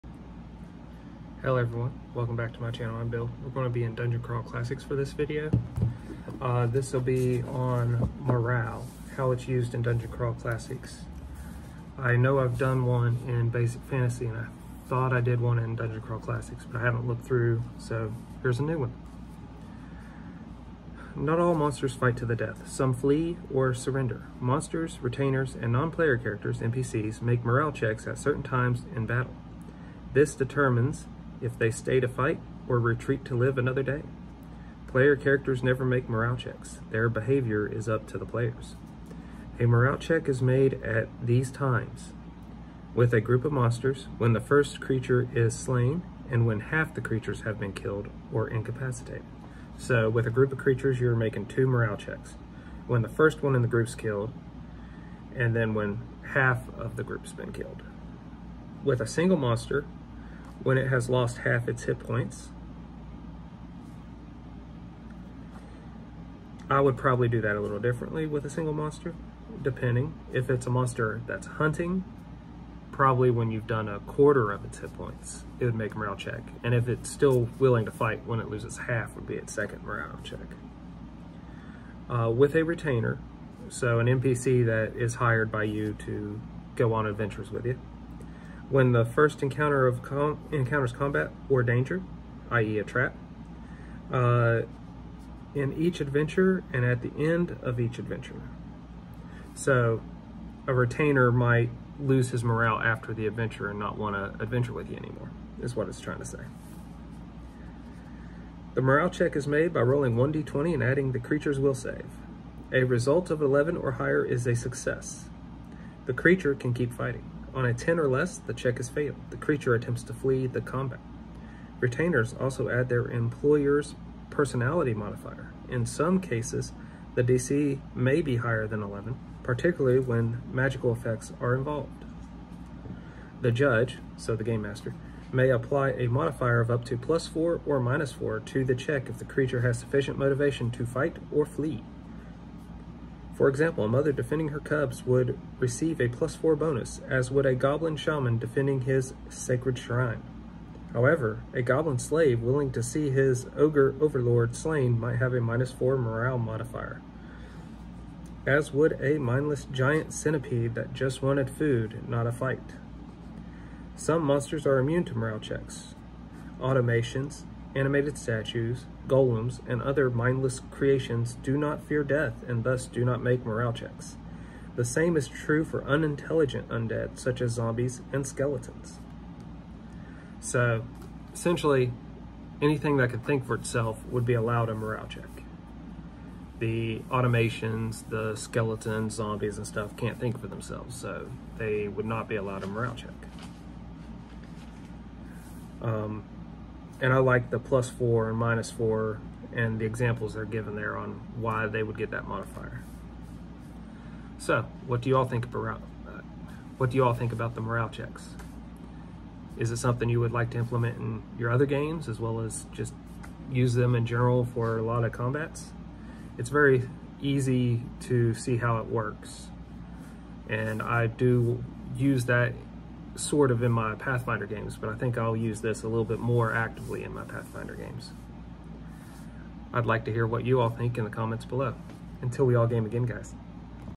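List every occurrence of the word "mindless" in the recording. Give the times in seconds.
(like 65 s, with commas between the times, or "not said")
159 s, 170 s.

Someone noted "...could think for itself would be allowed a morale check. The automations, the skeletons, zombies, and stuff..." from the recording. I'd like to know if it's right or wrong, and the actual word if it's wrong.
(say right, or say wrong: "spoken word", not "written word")
right.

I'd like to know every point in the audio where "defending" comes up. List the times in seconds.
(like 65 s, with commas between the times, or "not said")
144 s, 148 s.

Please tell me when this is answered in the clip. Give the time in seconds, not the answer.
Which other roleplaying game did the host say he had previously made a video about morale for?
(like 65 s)
13 s.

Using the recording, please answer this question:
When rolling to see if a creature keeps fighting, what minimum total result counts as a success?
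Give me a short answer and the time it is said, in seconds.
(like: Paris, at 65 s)
11, at 113 s.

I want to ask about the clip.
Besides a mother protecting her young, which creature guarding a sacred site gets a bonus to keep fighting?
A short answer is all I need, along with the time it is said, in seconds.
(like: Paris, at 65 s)
goblin shaman, at 147 s.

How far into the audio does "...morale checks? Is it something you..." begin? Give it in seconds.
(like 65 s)
207 s.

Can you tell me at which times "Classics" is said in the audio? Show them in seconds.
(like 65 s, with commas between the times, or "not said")
4 s, 10 s, 16 s.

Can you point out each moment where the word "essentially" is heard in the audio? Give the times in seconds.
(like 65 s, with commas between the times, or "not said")
181 s.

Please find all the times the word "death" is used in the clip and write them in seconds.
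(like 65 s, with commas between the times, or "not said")
22 s, 172 s.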